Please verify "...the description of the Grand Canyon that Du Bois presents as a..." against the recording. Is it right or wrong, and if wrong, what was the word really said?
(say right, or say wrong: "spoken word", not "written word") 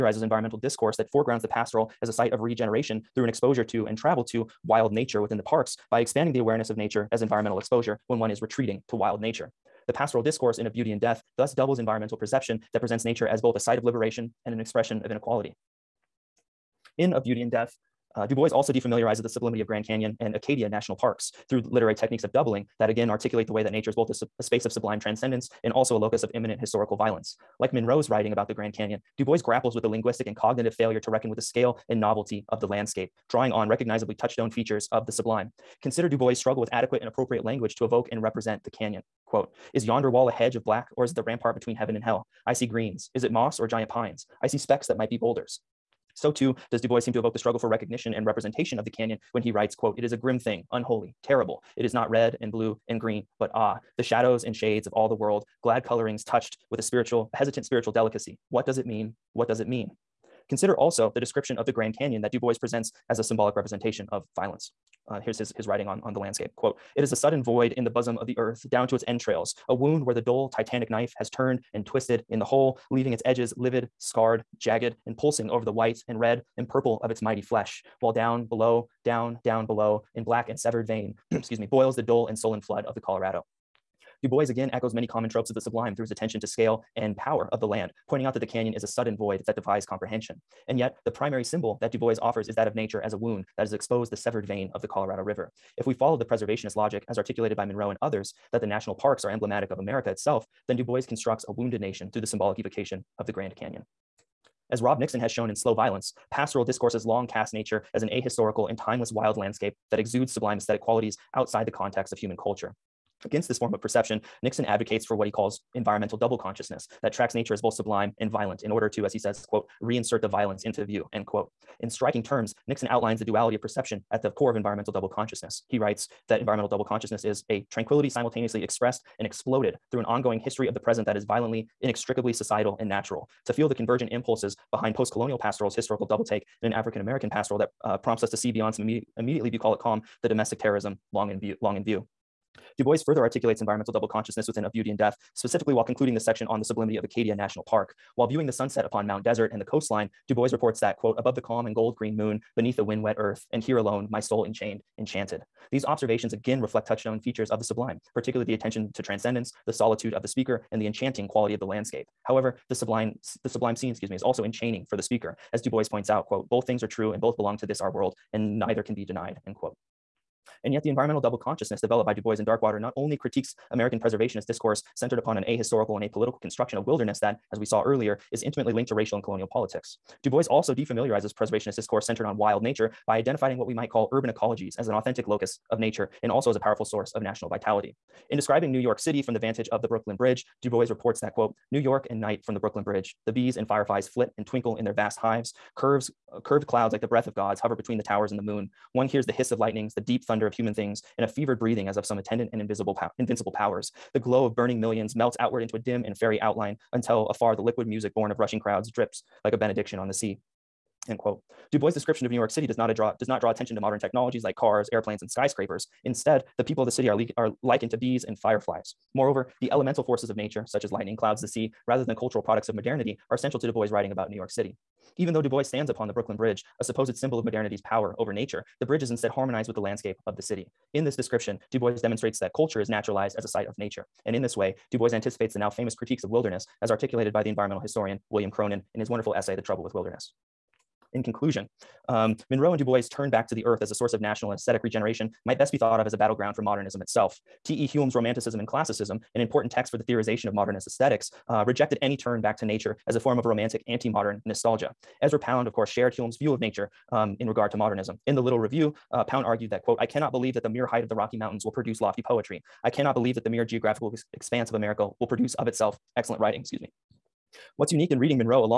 right.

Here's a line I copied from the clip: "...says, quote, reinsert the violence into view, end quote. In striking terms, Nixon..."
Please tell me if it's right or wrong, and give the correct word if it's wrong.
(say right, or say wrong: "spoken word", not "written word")
right.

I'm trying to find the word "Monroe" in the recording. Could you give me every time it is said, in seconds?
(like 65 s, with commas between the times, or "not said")
27 s, 97 s, 242 s.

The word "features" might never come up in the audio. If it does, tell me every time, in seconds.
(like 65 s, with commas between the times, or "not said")
34 s, 157 s.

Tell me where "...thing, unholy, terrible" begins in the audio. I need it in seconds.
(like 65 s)
50 s.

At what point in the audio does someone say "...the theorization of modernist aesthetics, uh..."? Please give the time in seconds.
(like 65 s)
249 s.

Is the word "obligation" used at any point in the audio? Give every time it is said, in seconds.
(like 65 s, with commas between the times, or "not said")
not said.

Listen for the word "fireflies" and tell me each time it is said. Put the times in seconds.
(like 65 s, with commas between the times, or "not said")
193 s, 218 s.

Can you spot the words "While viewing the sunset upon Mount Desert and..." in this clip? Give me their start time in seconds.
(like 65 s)
148 s.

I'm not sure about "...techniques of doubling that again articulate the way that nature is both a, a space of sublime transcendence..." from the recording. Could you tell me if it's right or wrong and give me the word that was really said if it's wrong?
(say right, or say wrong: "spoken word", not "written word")
right.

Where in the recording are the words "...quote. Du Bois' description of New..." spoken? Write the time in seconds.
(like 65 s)
211 s.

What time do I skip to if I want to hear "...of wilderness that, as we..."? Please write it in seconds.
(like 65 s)
176 s.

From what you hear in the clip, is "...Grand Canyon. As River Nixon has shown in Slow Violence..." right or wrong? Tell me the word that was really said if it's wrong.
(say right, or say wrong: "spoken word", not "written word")
wrong: "Rob", not "River".